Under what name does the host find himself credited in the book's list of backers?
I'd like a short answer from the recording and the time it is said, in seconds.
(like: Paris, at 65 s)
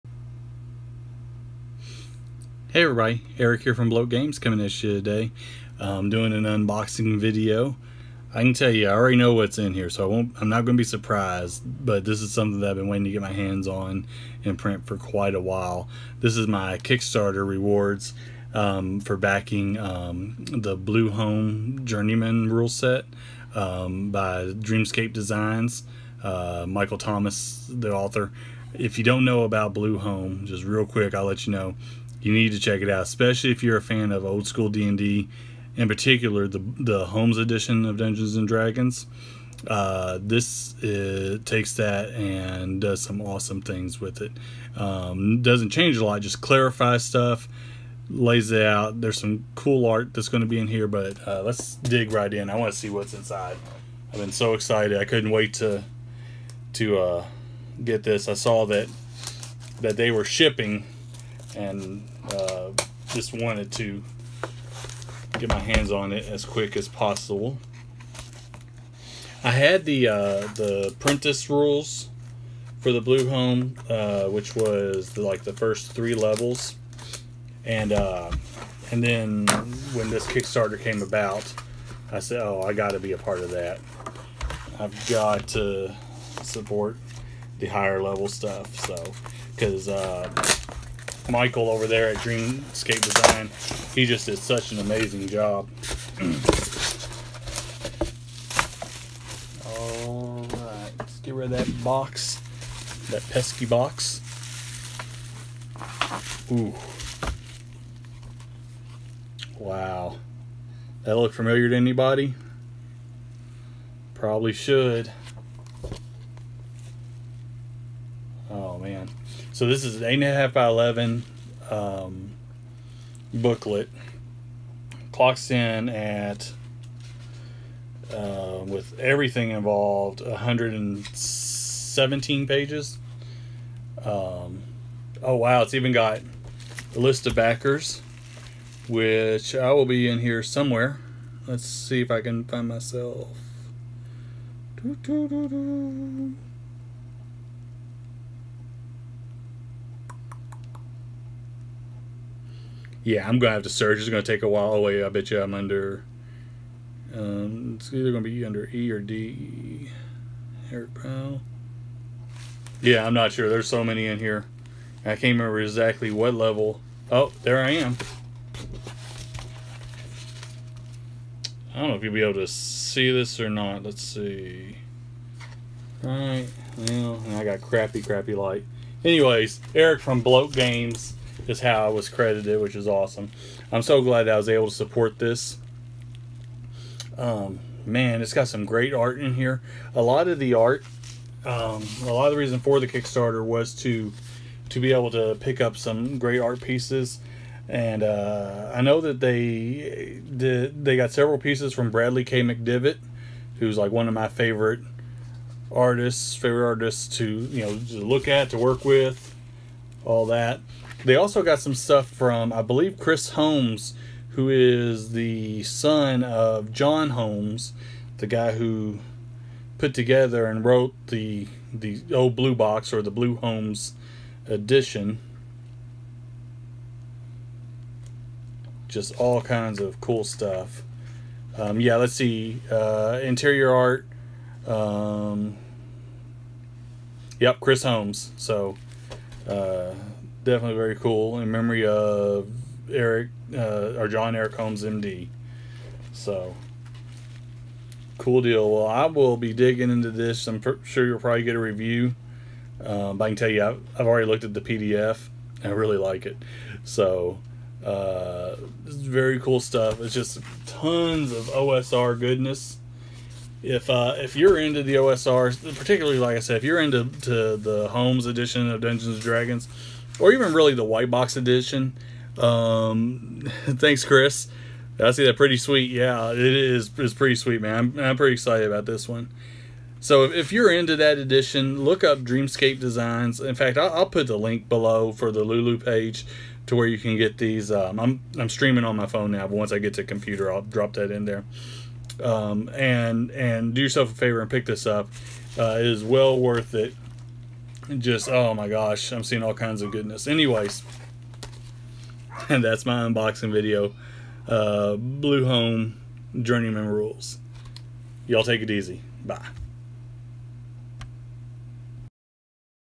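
Eric from Bloat Games, at 179 s.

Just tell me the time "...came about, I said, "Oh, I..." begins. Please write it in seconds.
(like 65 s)
80 s.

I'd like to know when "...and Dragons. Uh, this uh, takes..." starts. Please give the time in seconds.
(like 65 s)
38 s.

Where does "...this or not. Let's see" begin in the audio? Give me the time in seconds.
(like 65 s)
173 s.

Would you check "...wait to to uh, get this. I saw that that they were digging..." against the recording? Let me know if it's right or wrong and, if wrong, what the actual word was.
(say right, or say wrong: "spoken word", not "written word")
wrong: "shipping", not "digging".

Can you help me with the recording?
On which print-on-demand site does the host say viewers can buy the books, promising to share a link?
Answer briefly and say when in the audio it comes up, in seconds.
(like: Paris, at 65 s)
Lulu, at 285 s.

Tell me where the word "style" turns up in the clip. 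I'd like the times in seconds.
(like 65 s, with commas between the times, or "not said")
not said.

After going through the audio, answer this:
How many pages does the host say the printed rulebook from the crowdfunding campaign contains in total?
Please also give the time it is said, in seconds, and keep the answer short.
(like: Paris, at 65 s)
117, at 130 s.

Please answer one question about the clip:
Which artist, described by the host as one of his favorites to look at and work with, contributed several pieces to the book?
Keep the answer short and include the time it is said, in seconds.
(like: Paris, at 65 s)
Bradley K. McDevitt, at 201 s.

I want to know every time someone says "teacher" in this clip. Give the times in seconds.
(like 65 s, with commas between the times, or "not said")
not said.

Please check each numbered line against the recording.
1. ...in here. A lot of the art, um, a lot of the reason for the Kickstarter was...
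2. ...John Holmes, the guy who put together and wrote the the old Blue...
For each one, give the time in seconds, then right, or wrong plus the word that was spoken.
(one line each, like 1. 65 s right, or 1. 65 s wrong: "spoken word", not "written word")
1. 189 s right
2. 216 s right.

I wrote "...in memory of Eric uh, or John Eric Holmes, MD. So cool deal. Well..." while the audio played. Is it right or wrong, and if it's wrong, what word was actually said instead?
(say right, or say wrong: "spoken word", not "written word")
right.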